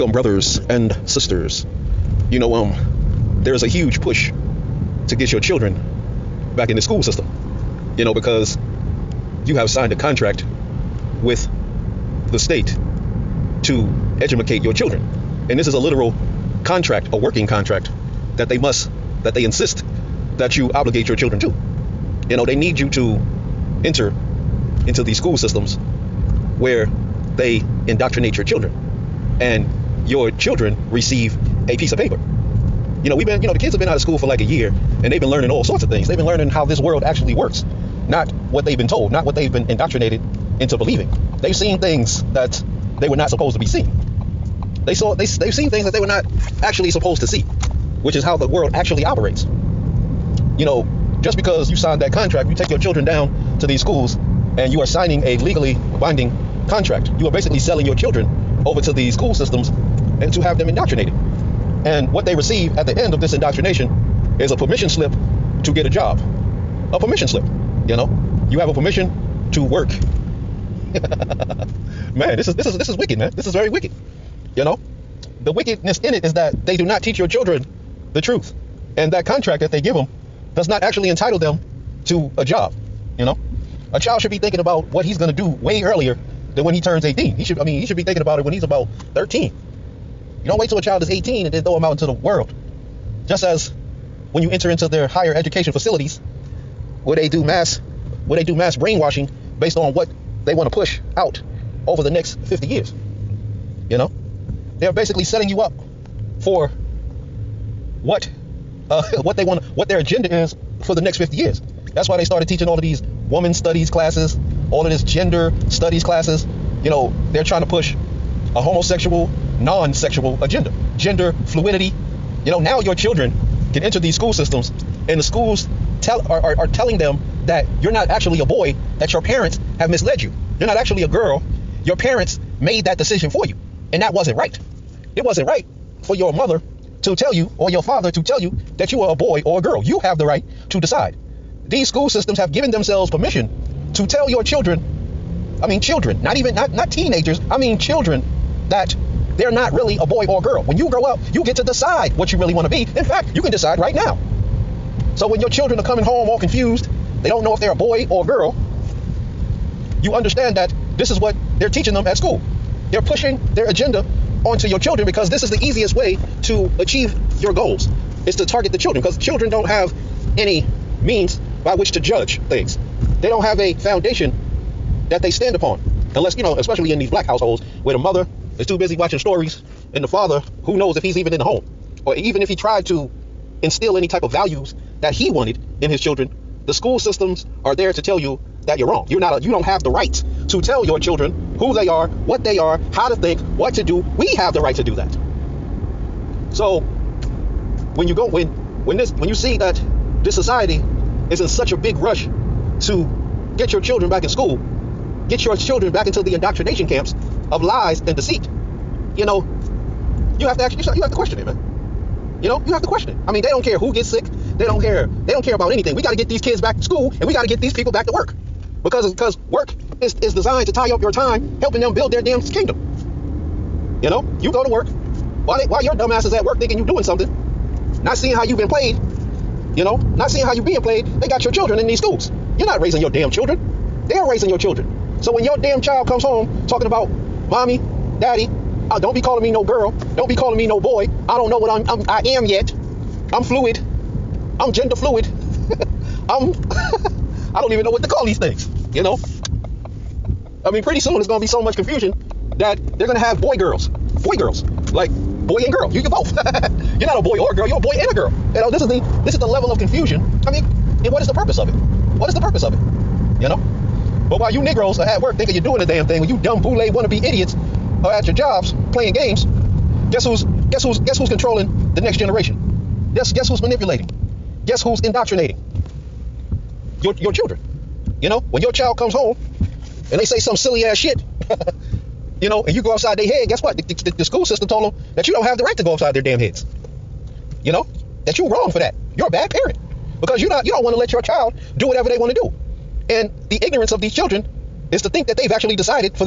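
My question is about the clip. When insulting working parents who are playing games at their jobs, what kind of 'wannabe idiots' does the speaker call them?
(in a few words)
boule wannabe idiots.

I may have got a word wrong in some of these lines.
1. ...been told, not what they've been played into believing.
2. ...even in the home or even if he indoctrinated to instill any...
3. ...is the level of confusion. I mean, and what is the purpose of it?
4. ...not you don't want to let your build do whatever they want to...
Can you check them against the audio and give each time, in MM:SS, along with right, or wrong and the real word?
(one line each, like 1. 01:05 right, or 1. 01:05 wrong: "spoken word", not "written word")
1. 00:38 wrong: "indoctrinated", not "played"
2. 03:01 wrong: "tried", not "indoctrinated"
3. 04:19 right
4. 04:50 wrong: "child", not "build".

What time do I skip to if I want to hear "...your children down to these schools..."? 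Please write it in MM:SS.
00:52.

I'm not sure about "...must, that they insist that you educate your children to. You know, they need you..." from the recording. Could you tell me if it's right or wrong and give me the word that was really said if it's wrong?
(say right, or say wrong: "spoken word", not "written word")
wrong: "obligate", not "educate".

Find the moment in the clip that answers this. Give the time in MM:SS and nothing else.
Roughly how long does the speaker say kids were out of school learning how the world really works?
00:34.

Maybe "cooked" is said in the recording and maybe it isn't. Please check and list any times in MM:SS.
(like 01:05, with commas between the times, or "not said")
not said.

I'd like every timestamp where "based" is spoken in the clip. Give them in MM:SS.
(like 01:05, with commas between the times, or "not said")
01:39.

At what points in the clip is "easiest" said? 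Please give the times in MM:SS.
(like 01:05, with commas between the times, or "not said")
02:45.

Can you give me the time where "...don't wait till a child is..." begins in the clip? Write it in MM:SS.
01:30.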